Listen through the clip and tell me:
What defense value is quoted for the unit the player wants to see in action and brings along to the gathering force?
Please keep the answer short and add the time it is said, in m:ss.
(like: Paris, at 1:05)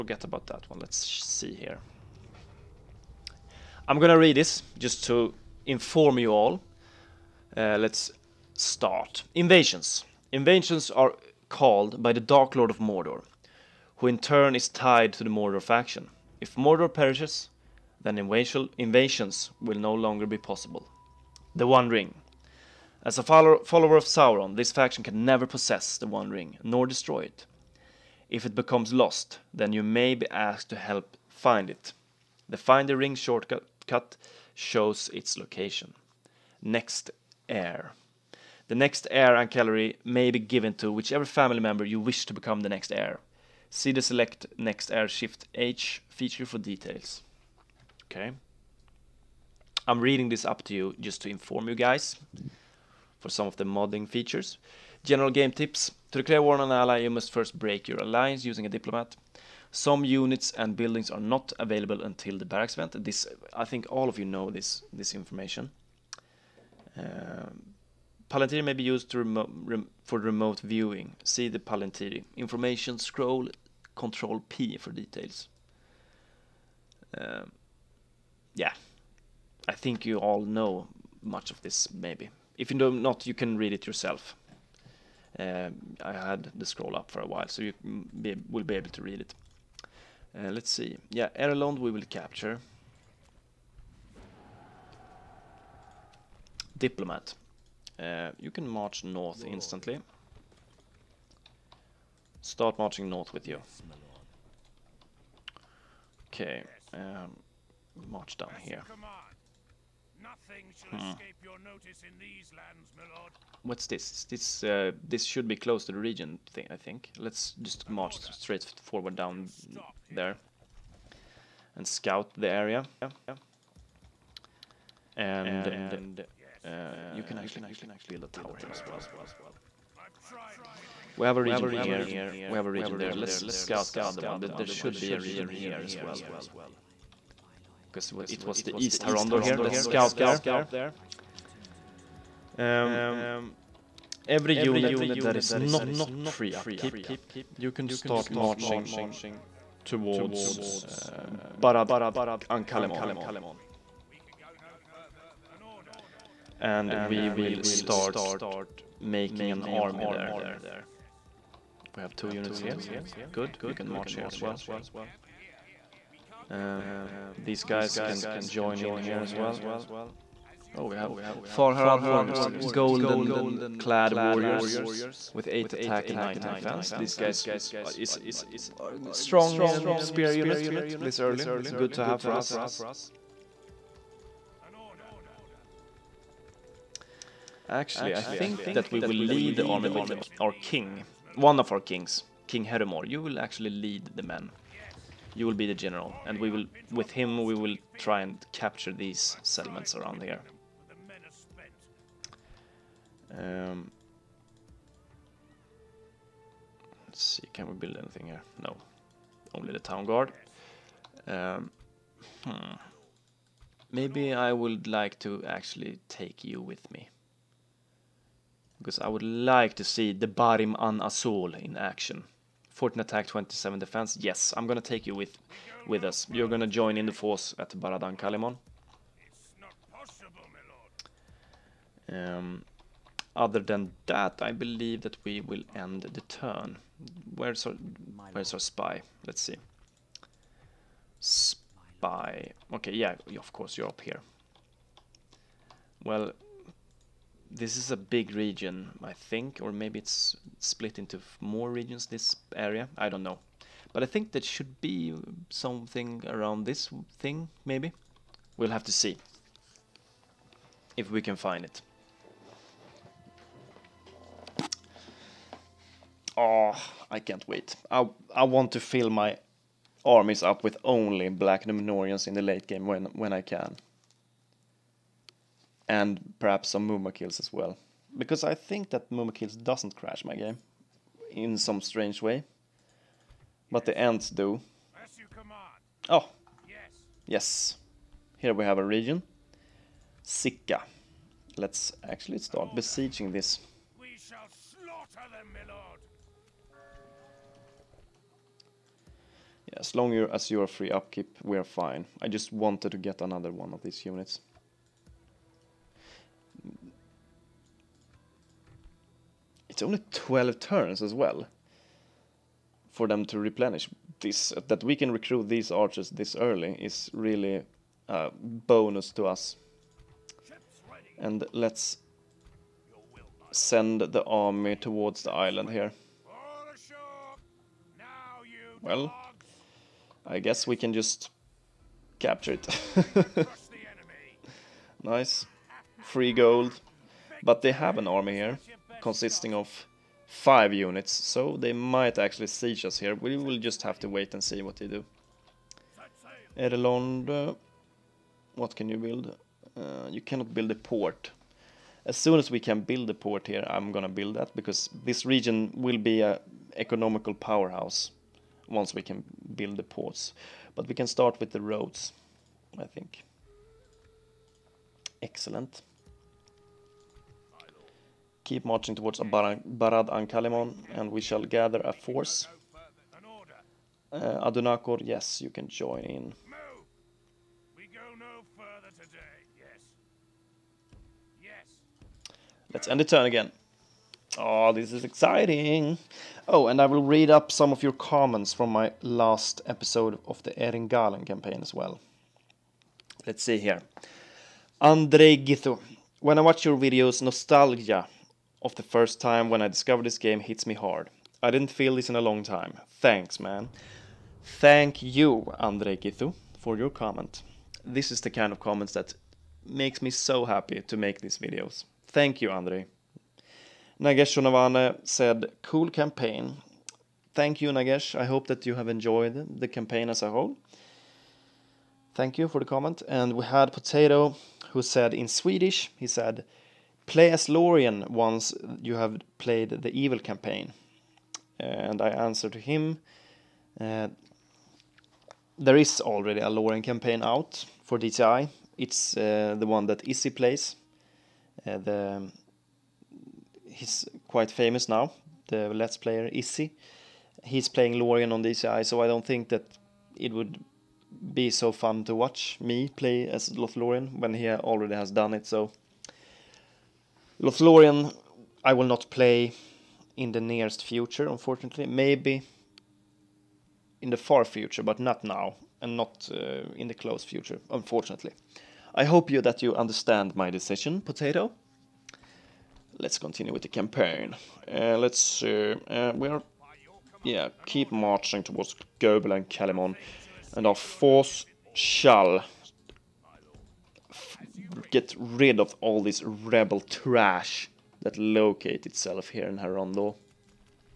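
27, at 3:43.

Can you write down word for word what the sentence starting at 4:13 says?
But I think that should be something around this thing, maybe.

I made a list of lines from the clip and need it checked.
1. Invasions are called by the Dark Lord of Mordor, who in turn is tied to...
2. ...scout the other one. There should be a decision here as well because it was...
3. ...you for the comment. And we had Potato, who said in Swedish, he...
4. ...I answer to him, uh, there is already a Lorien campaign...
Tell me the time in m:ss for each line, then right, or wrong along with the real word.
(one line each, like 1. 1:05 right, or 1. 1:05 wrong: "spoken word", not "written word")
1. 0:10 right
2. 2:13 wrong: "region", not "decision"
3. 7:02 right
4. 7:12 right.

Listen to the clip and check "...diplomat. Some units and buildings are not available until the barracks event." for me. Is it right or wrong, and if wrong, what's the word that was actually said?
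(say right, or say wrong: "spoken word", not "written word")
right.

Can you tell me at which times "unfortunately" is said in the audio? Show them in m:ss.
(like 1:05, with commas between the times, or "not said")
7:41, 7:47.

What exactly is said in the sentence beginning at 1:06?
Uh, Palantir may be used remo rem for remote viewing.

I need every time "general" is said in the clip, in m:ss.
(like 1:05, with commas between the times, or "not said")
0:55, 3:15.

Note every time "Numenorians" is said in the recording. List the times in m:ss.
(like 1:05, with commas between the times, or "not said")
4:31.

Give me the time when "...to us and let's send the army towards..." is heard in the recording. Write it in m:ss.
5:19.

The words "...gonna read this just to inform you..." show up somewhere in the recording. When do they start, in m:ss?
0:03.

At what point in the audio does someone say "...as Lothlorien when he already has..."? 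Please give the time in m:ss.
7:33.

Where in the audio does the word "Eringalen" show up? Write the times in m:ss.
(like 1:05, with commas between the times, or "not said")
6:30.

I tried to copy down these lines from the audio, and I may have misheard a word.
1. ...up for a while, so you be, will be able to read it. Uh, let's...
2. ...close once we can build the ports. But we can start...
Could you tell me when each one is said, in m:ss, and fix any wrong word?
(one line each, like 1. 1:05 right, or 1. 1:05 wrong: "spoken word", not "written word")
1. 1:26 right
2. 5:57 wrong: "powerhouse", not "close".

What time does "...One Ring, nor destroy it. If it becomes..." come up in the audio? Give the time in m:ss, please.
0:26.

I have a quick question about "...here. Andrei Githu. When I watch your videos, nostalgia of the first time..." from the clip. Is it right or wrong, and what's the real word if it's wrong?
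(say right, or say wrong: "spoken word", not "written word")
right.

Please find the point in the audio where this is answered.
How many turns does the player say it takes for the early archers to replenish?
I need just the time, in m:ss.
5:10.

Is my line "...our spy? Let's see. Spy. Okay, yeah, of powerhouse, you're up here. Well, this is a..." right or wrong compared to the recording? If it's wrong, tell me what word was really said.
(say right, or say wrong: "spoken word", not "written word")
wrong: "course", not "powerhouse".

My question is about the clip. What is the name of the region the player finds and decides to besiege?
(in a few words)
Sika.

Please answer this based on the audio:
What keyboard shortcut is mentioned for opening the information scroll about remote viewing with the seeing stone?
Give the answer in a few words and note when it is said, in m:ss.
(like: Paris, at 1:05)
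Control P, at 1:13.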